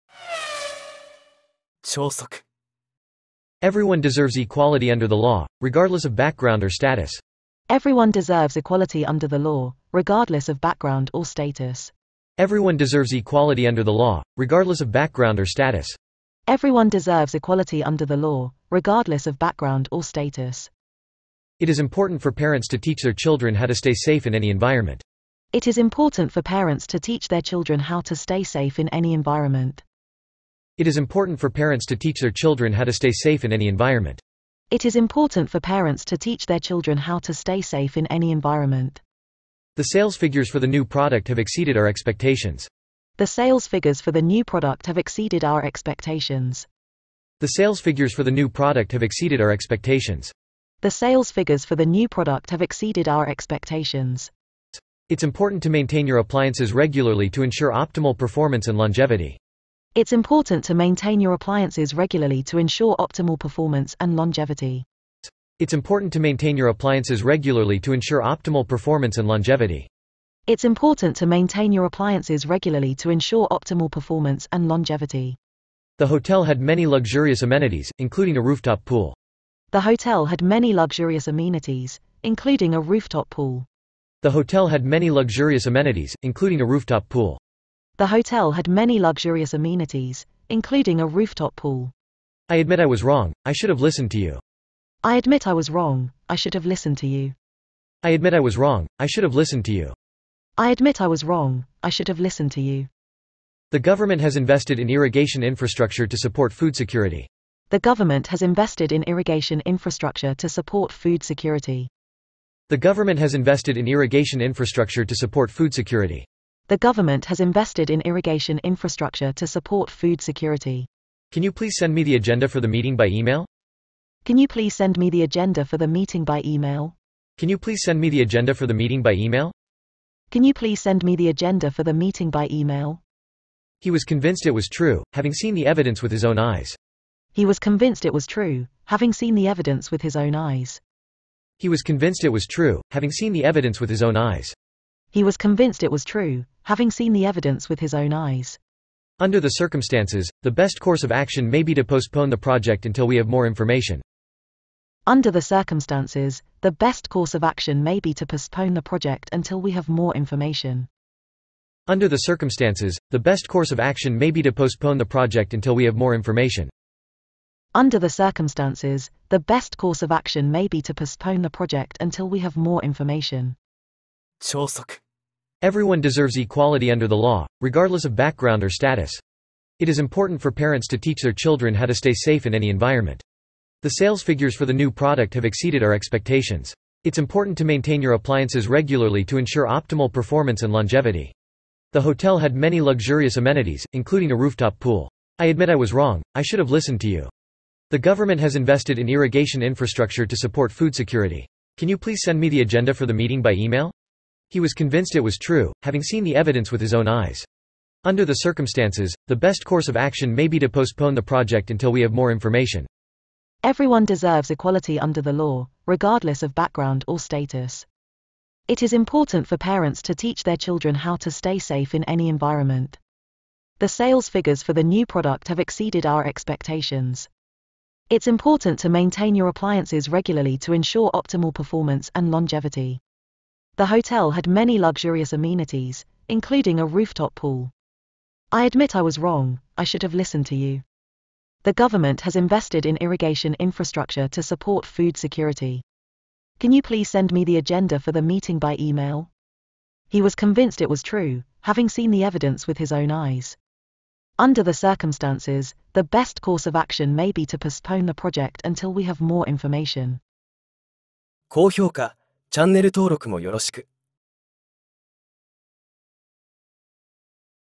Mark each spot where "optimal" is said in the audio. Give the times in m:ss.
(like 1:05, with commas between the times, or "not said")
0:57, 1:02, 1:08, 1:13, 3:09, 3:51.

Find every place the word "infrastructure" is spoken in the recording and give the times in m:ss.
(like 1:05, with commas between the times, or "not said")
1:45, 1:49, 1:54, 1:58, 3:19, 4:03.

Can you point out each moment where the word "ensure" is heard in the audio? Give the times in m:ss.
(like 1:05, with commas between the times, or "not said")
0:57, 1:02, 1:07, 1:13, 3:09, 3:50.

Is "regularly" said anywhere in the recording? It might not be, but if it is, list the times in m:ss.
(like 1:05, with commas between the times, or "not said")
0:56, 1:01, 1:07, 1:12, 3:08, 3:50.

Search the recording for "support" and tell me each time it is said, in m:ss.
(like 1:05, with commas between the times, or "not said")
1:46, 1:50, 1:55, 1:59, 3:20, 4:04.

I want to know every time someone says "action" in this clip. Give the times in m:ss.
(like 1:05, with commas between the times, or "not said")
2:31, 2:37, 2:43, 2:50, 3:29, 4:16.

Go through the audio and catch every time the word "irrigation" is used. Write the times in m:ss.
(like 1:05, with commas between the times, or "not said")
1:44, 1:49, 1:53, 1:58, 3:19, 4:02.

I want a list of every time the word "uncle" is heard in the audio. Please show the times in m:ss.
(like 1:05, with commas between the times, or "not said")
not said.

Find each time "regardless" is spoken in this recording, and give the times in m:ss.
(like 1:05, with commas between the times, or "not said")
0:05, 0:09, 0:14, 0:18, 2:57, 3:35.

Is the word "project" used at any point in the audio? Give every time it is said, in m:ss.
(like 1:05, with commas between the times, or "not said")
2:32, 2:38, 2:45, 2:51, 3:31, 4:18.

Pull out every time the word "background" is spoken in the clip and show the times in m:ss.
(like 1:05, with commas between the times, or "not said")
0:06, 0:10, 0:14, 0:19, 2:58, 3:36.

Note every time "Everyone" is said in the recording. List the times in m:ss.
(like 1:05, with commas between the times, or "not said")
0:03, 0:07, 0:12, 0:16, 2:55, 3:33.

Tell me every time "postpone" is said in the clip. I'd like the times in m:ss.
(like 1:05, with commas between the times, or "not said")
2:31, 2:38, 2:44, 2:50, 3:30, 4:17.